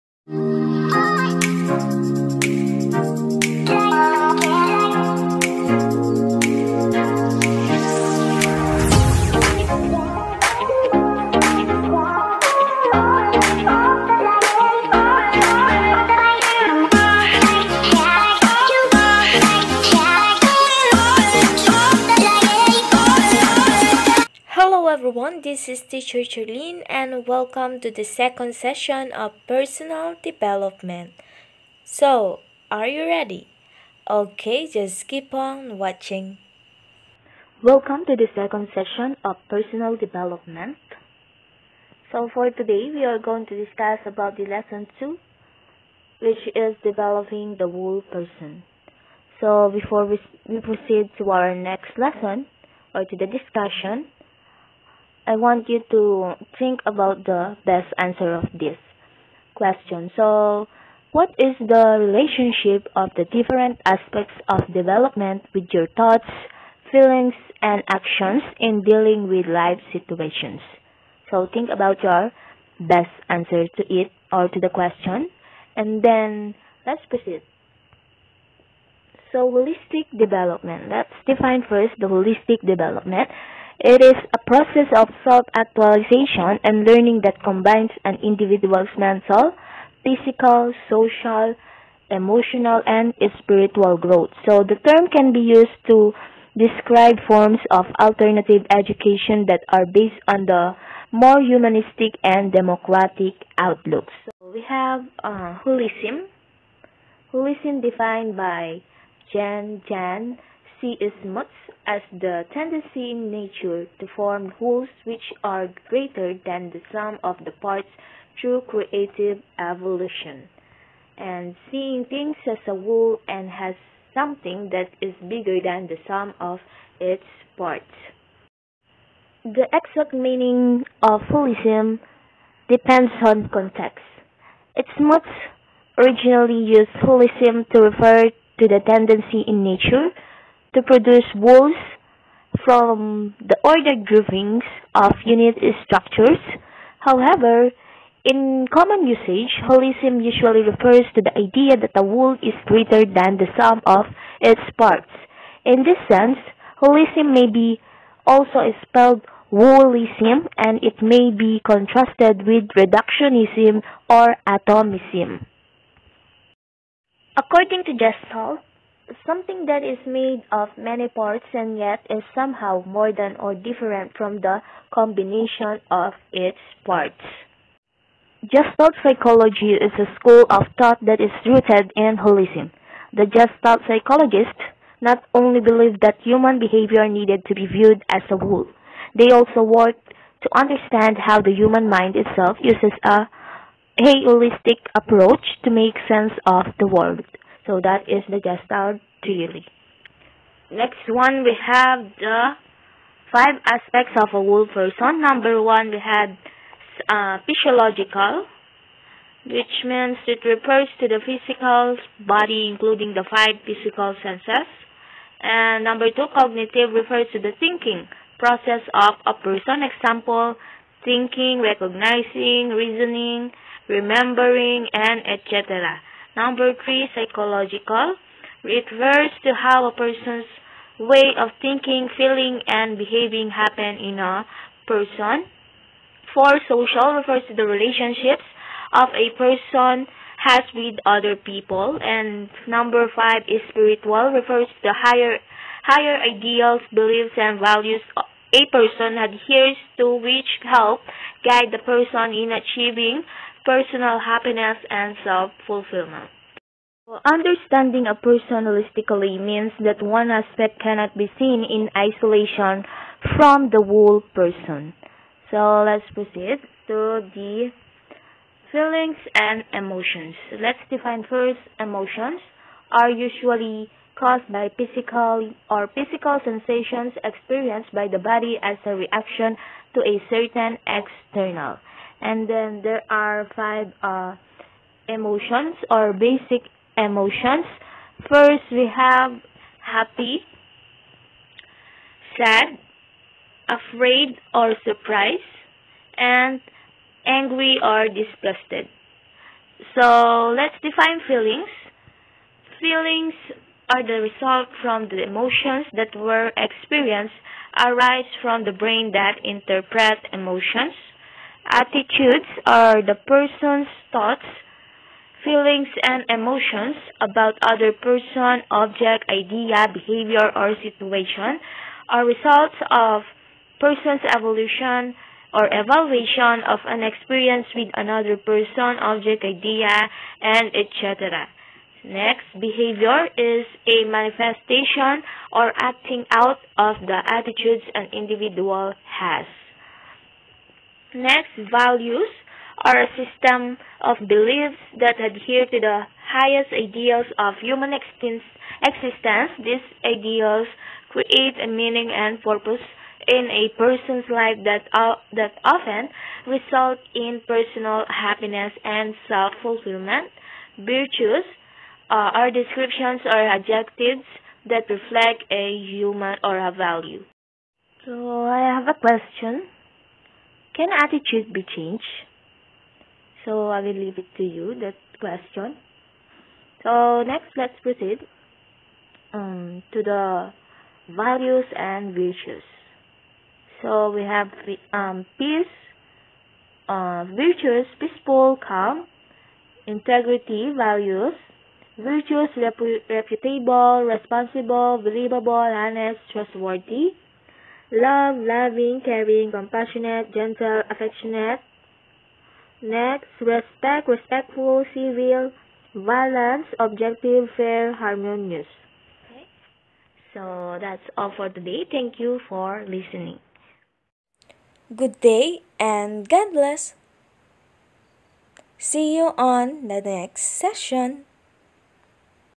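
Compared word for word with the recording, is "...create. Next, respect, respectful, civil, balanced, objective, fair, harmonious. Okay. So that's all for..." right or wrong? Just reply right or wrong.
wrong.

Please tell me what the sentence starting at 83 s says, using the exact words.
It is a process of self-actualization and learning that combines an individual's mental, physical, social, emotional, and spiritual growth.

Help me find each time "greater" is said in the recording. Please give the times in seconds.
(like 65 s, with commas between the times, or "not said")
115 s, 152 s.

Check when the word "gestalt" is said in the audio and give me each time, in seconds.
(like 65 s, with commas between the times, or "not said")
167 s, 178 s, 183 s, 198 s.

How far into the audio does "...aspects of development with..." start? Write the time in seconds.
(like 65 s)
63 s.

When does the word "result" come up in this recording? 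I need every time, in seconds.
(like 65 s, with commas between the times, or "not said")
304 s, 322 s, 356 s.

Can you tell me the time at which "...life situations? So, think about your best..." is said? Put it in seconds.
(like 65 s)
69 s.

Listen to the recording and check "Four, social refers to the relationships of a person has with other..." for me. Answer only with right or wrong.
right.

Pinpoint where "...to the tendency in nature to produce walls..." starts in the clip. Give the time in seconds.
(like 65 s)
138 s.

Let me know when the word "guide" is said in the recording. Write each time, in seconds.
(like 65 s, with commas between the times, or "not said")
251 s.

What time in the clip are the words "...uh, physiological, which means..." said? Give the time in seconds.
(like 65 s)
207 s.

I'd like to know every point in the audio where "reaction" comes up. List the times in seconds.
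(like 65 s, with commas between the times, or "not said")
278 s.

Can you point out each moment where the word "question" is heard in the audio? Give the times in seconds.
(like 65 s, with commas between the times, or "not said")
59 s, 74 s, 368 s, 375 s.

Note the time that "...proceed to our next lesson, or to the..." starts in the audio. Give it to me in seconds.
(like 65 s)
50 s.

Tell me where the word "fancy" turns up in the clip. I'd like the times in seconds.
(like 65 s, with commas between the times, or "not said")
not said.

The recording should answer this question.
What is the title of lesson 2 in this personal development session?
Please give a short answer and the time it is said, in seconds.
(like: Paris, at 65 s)
Developing the whole person, at 46 s.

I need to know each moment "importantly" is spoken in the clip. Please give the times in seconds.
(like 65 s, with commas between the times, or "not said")
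not said.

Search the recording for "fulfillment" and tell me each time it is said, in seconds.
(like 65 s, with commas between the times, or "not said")
255 s, 359 s.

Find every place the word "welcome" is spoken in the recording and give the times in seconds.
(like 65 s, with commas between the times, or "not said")
27 s, 37 s.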